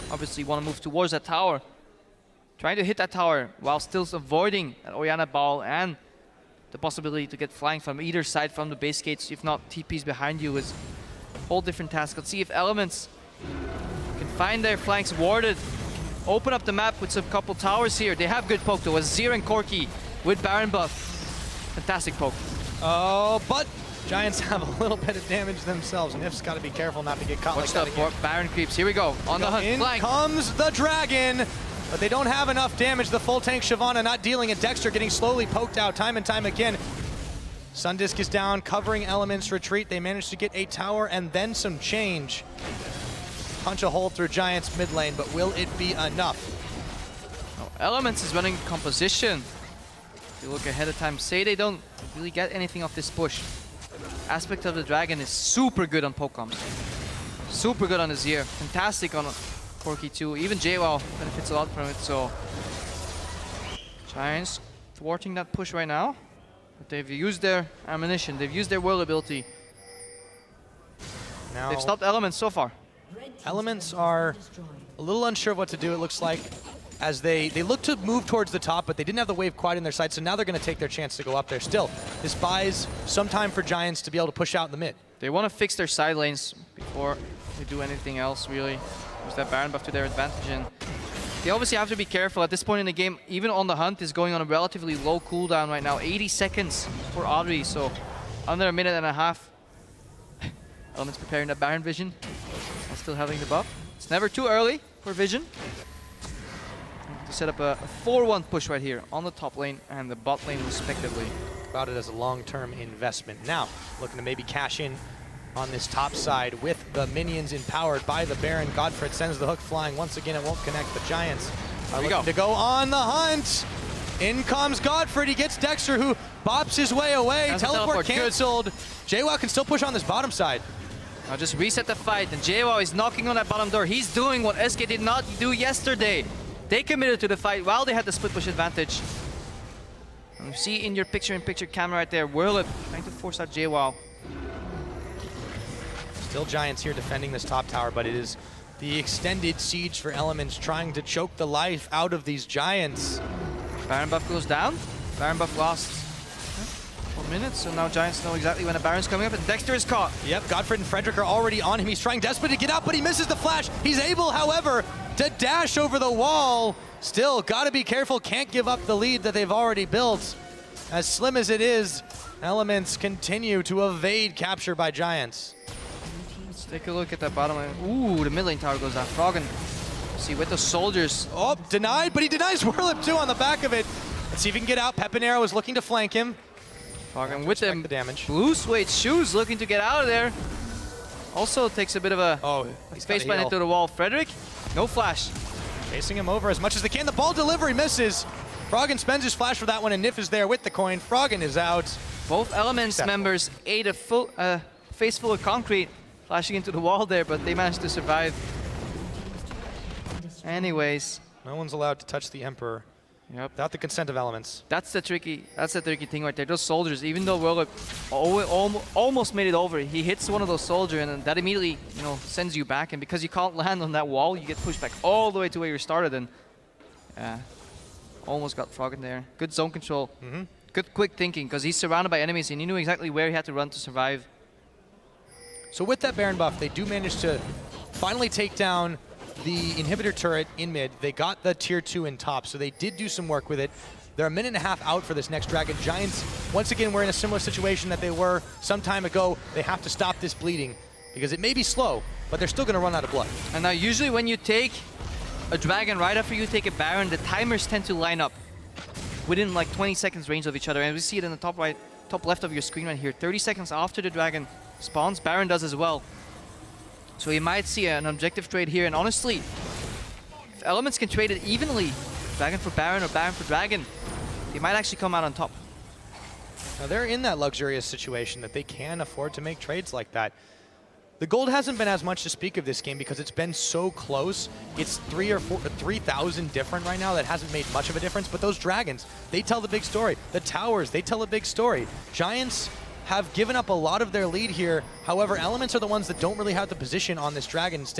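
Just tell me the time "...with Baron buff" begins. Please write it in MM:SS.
00:20.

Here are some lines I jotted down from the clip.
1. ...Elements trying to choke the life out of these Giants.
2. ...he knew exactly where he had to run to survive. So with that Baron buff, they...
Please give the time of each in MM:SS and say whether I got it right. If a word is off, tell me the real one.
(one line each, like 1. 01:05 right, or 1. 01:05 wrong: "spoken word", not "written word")
1. 02:30 right
2. 03:52 right.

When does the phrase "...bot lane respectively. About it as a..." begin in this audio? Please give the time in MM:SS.
01:50.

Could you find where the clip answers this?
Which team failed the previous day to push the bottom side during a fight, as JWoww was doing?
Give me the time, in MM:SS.
02:14.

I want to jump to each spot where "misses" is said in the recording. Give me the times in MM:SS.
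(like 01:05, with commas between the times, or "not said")
02:43, 03:17.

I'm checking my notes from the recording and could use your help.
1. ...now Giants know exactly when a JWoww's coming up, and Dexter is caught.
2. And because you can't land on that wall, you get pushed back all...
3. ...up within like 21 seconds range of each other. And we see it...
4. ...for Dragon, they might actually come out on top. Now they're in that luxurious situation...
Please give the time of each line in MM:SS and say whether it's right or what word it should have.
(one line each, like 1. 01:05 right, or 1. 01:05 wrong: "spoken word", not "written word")
1. 02:37 wrong: "Baron", not "JWoww"
2. 03:42 right
3. 04:18 wrong: "20", not "21"
4. 04:33 right.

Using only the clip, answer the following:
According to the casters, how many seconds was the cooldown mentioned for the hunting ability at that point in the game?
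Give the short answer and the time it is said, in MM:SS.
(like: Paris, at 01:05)
80, at 01:35.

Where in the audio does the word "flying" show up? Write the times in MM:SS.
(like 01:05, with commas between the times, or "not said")
00:07, 01:59.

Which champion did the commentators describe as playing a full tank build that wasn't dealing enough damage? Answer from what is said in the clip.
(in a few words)
Shyvana.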